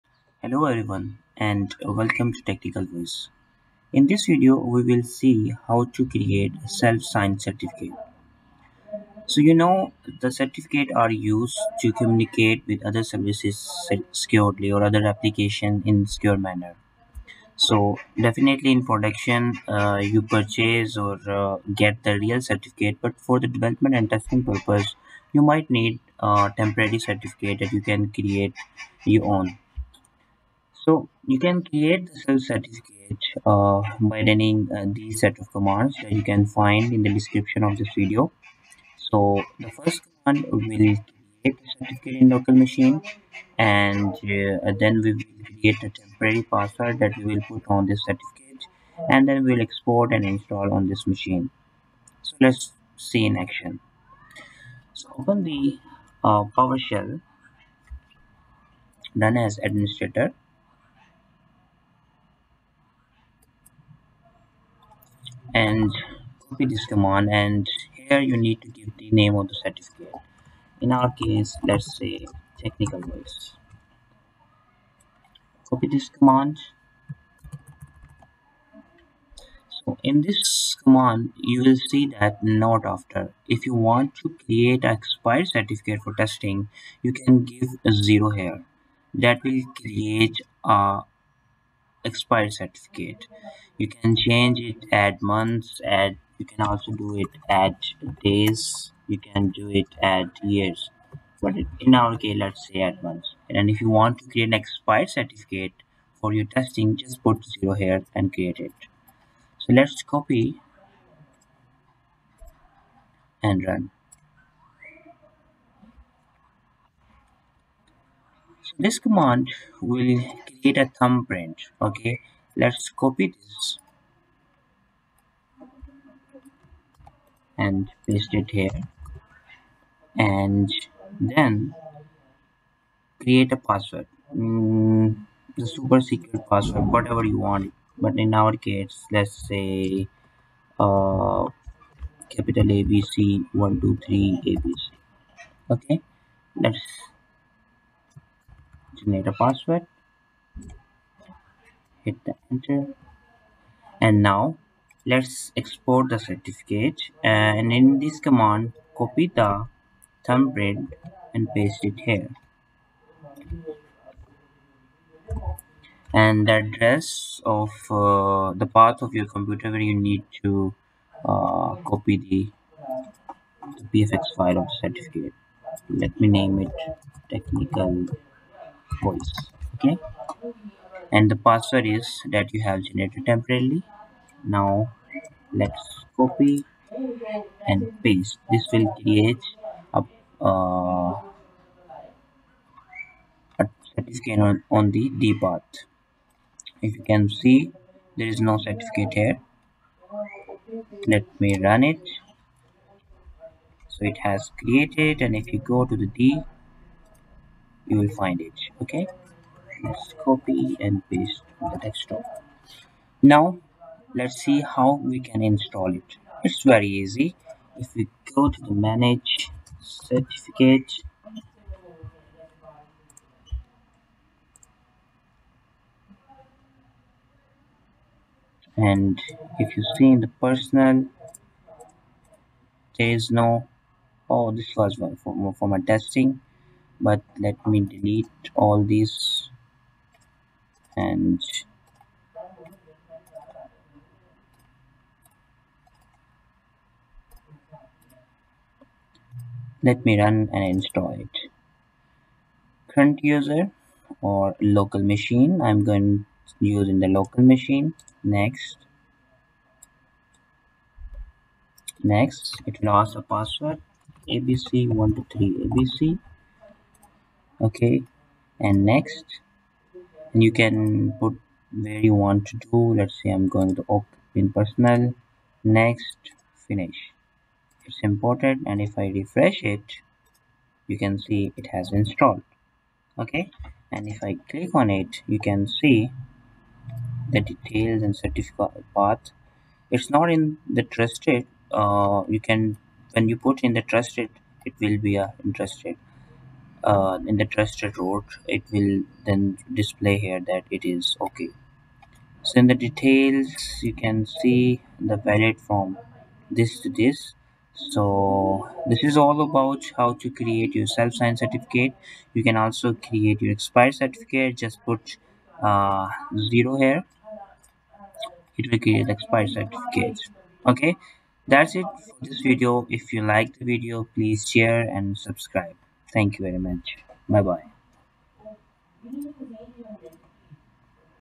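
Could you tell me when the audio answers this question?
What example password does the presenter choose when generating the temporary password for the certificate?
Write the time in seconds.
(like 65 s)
142 s.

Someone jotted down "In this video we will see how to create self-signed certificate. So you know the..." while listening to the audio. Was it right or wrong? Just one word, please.
right.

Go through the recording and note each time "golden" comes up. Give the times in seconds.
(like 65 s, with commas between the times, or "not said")
not said.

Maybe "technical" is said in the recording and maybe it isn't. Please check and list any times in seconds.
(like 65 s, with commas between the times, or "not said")
2 s, 72 s, 177 s.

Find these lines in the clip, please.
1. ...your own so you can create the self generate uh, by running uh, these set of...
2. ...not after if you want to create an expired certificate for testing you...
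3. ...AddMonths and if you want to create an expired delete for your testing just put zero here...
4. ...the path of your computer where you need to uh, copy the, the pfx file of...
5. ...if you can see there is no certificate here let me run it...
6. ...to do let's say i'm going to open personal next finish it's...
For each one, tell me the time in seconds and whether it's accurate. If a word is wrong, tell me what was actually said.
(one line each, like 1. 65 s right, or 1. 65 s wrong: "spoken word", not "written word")
1. 29 s wrong: "certificate", not "generate"
2. 82 s right
3. 102 s wrong: "certificate", not "delete"
4. 168 s right
5. 196 s right
6. 272 s right.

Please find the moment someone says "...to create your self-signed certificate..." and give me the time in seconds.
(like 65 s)
310 s.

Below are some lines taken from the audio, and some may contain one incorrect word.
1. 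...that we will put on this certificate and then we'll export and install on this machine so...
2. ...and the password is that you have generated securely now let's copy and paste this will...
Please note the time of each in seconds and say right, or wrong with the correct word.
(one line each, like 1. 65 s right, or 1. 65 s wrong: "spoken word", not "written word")
1. 47 s right
2. 181 s wrong: "temporarily", not "securely".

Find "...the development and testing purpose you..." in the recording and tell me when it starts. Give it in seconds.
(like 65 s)
23 s.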